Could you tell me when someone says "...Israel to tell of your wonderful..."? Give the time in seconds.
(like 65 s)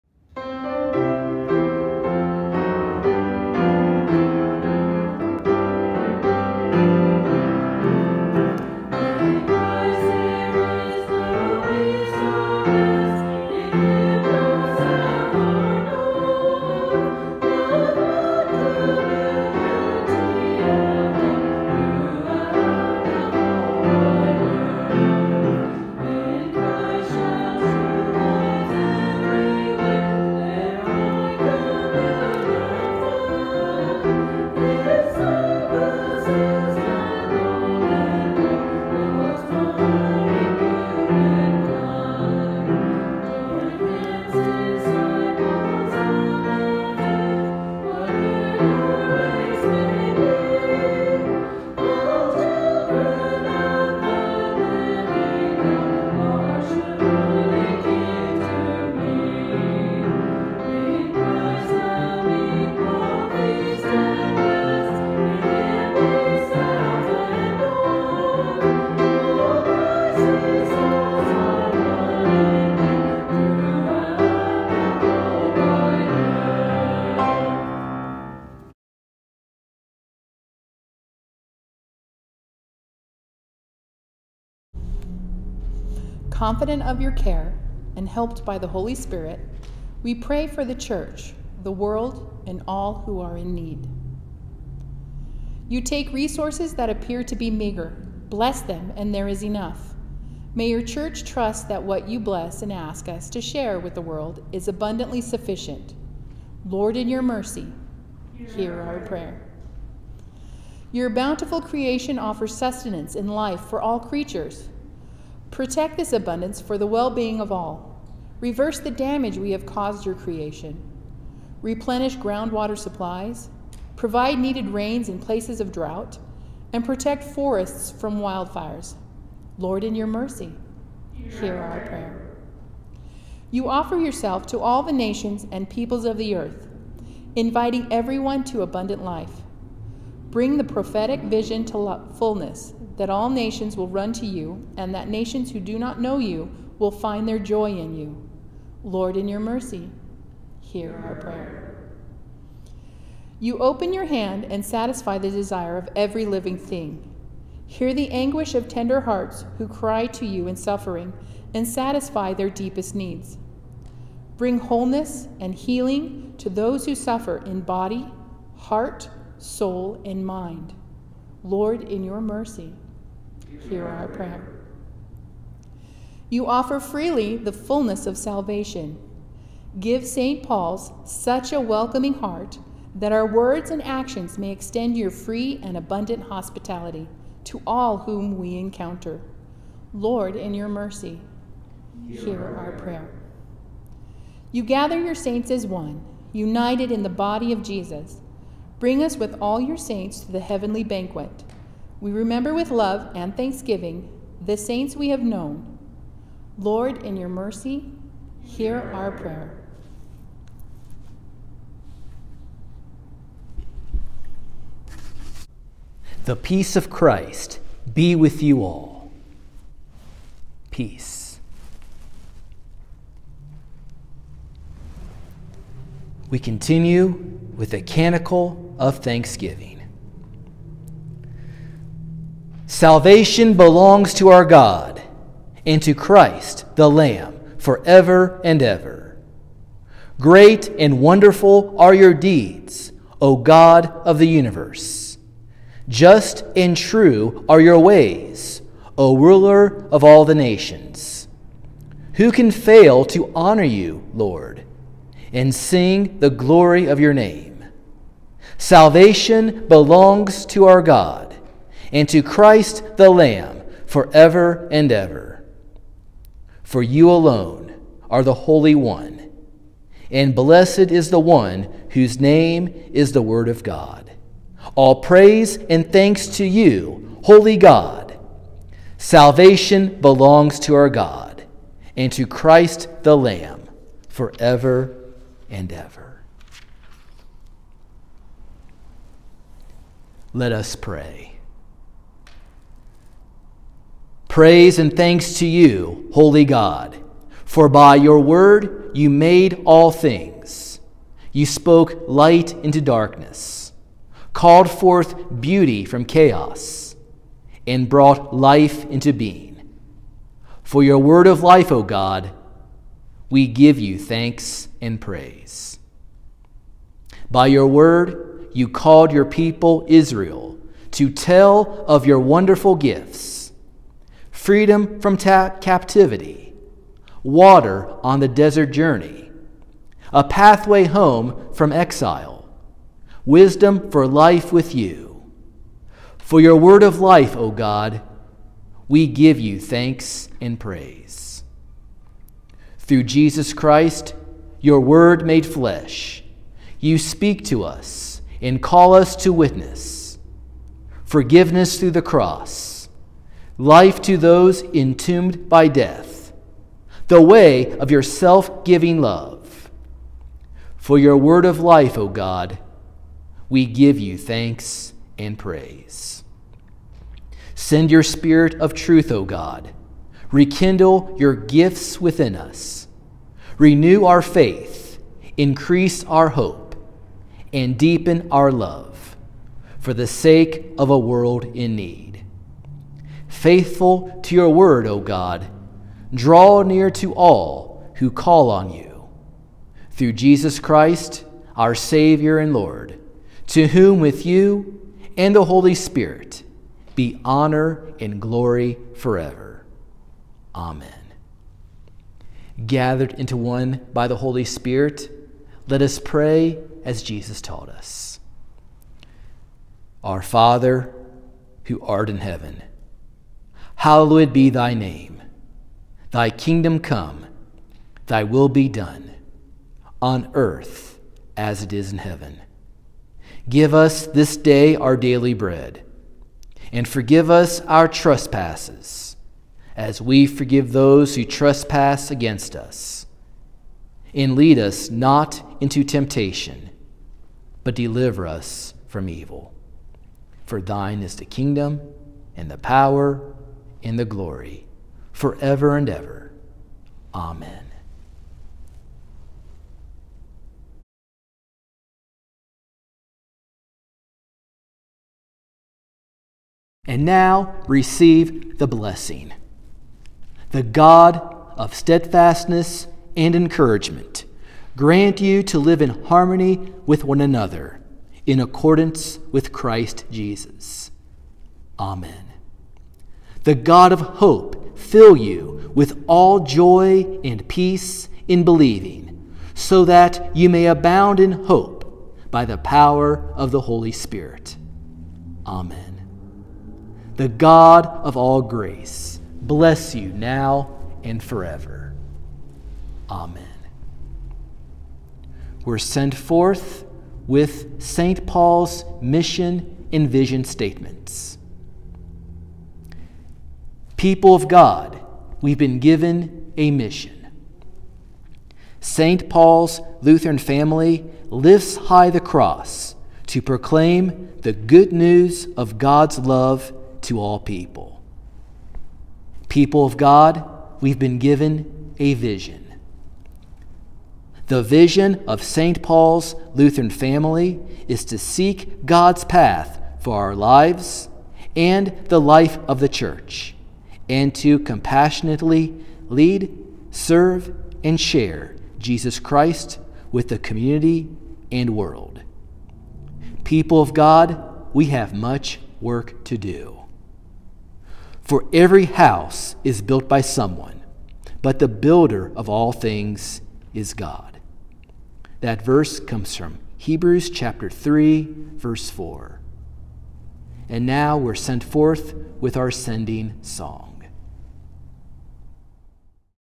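319 s.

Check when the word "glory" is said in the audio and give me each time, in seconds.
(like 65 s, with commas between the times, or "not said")
256 s, 398 s, 444 s.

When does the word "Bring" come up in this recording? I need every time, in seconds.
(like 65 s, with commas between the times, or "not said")
140 s, 164 s, 198 s.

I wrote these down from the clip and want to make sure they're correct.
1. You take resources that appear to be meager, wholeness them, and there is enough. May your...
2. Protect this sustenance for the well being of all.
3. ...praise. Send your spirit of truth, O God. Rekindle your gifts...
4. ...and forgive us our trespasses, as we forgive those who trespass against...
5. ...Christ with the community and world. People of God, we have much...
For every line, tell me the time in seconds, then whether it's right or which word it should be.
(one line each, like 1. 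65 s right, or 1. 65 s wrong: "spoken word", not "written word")
1. 95 s wrong: "bless", not "wholeness"
2. 115 s wrong: "abundance", not "sustenance"
3. 365 s right
4. 426 s right
5. 539 s right.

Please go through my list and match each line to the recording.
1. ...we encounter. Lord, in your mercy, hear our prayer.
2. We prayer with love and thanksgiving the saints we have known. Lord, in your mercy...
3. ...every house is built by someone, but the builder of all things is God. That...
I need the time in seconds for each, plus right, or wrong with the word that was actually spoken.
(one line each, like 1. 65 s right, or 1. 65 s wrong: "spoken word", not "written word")
1. 188 s right
2. 201 s wrong: "remember", not "prayer"
3. 548 s right.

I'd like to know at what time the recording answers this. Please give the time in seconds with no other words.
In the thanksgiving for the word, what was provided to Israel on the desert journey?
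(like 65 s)
327 s.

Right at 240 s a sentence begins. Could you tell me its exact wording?
Great and wonderful are your deeds, O God of the universe.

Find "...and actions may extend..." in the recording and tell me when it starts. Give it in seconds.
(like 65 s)
183 s.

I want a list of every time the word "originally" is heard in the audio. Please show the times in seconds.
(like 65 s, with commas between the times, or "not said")
not said.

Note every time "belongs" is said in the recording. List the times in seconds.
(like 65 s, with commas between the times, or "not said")
233 s, 259 s, 280 s.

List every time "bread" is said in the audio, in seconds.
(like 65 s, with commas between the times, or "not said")
425 s.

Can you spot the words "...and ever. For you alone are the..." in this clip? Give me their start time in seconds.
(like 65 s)
264 s.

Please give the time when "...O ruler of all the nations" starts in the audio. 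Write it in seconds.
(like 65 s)
248 s.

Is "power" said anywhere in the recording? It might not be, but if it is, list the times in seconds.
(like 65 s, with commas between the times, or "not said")
442 s, 482 s.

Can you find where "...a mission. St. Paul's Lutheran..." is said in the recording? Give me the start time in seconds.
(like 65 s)
506 s.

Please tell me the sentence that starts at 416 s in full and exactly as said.
Thy kingdom come, thy will be done, on earth as it is in heaven.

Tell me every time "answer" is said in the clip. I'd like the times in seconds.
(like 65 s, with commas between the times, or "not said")
not said.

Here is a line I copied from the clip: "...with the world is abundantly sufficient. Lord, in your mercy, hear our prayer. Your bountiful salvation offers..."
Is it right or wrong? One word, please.
wrong.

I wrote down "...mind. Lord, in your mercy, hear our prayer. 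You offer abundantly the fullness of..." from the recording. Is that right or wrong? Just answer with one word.
wrong.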